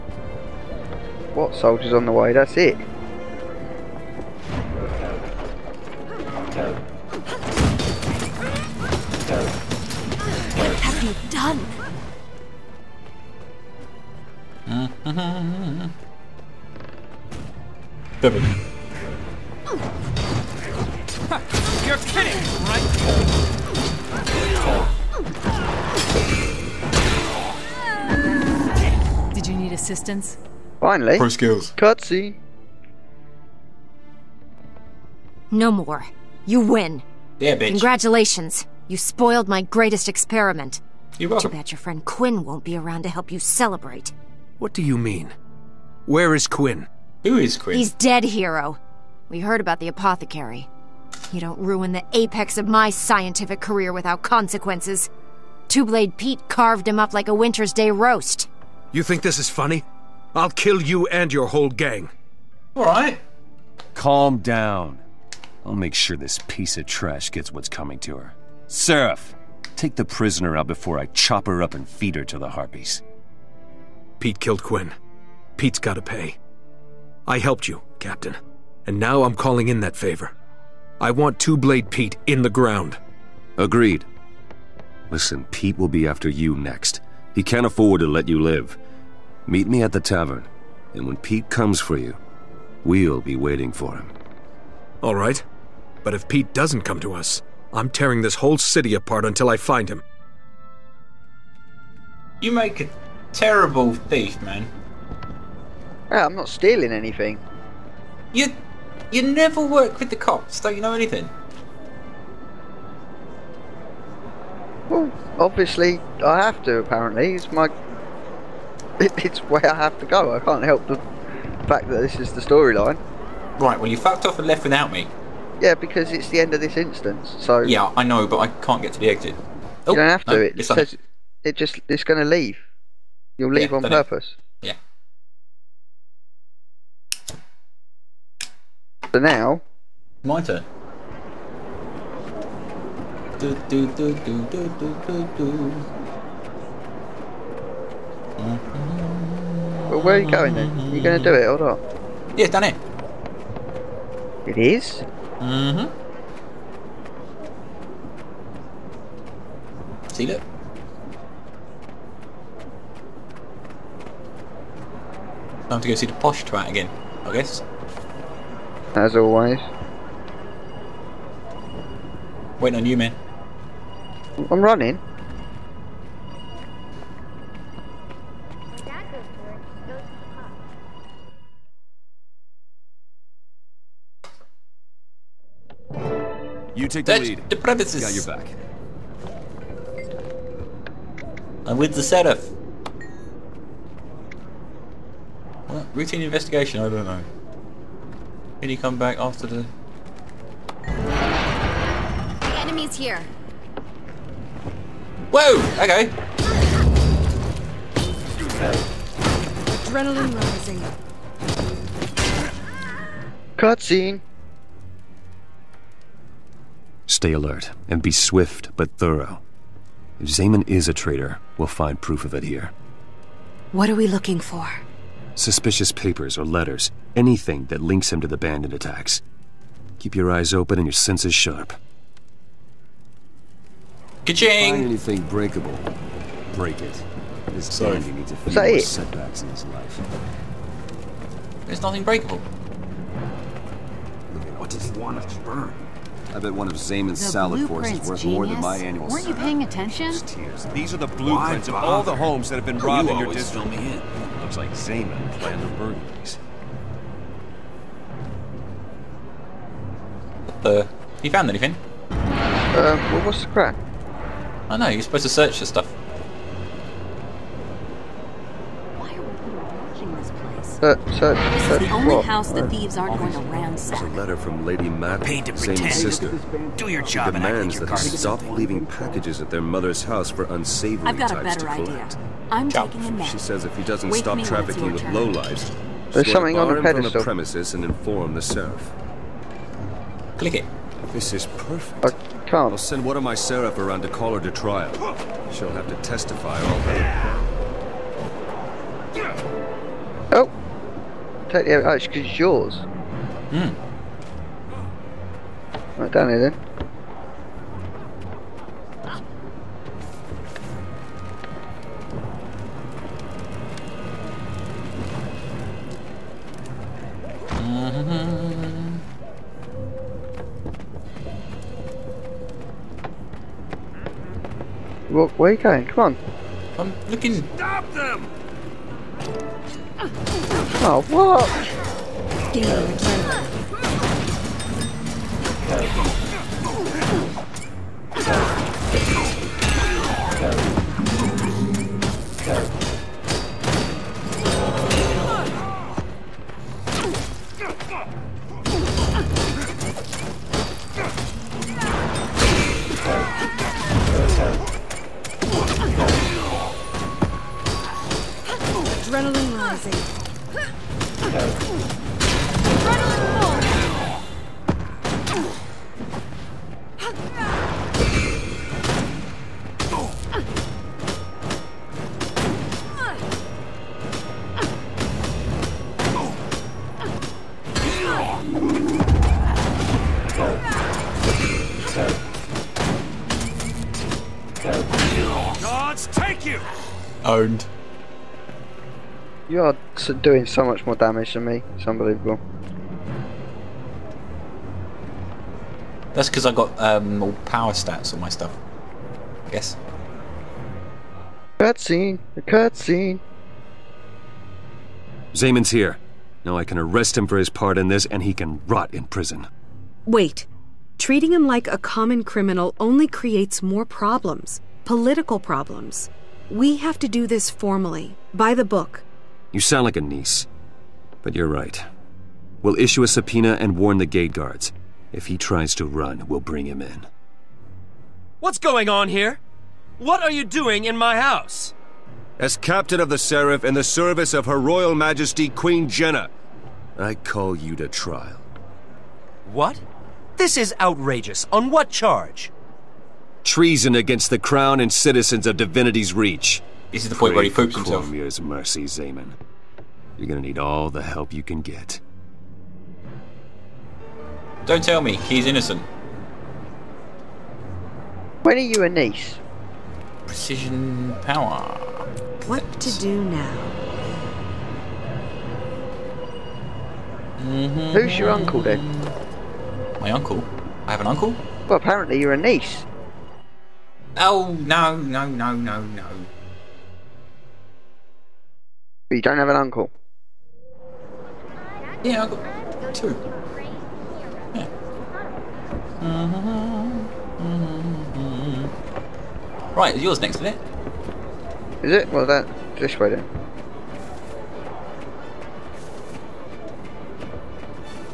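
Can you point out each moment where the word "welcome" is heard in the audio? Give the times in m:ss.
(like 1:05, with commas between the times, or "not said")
0:41.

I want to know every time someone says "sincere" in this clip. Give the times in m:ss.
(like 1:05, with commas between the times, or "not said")
not said.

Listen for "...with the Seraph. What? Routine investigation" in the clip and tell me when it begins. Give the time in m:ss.
3:11.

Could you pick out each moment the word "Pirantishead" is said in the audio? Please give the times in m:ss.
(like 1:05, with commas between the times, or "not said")
not said.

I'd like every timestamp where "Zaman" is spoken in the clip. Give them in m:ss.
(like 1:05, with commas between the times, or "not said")
3:40, 4:06, 6:45, 7:28.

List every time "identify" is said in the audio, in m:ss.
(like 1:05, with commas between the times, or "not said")
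not said.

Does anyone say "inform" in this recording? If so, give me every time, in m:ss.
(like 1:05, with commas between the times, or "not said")
4:47.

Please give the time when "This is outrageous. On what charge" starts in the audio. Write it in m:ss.
7:20.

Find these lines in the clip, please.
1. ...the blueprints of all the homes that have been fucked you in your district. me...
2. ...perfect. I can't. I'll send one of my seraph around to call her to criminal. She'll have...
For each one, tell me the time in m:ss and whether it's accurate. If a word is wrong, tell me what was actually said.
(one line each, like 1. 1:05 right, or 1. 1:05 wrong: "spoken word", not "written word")
1. 4:10 wrong: "robbed", not "fucked"
2. 4:51 wrong: "trial", not "criminal".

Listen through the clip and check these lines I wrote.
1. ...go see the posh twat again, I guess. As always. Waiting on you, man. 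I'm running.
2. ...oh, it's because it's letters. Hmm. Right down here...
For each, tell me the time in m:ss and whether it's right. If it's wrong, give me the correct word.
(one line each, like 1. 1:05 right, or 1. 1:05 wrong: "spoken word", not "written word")
1. 2:45 right
2. 5:01 wrong: "yours", not "letters".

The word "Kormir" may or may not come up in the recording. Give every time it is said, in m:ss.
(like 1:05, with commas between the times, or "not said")
7:28.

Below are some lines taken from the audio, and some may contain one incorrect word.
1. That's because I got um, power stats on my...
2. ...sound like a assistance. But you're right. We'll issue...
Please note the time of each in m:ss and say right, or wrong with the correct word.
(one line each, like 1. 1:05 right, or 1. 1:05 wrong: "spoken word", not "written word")
1. 6:36 right
2. 6:59 wrong: "niece", not "assistance".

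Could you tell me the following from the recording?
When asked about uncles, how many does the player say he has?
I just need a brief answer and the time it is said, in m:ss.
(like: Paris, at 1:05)
2, at 8:02.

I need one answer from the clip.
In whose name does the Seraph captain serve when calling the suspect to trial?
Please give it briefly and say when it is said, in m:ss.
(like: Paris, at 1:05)
Queen Jennah, at 7:14.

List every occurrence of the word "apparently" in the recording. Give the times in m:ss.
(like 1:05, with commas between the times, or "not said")
1:56, 7:51.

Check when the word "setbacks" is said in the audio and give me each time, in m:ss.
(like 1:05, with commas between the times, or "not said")
3:58.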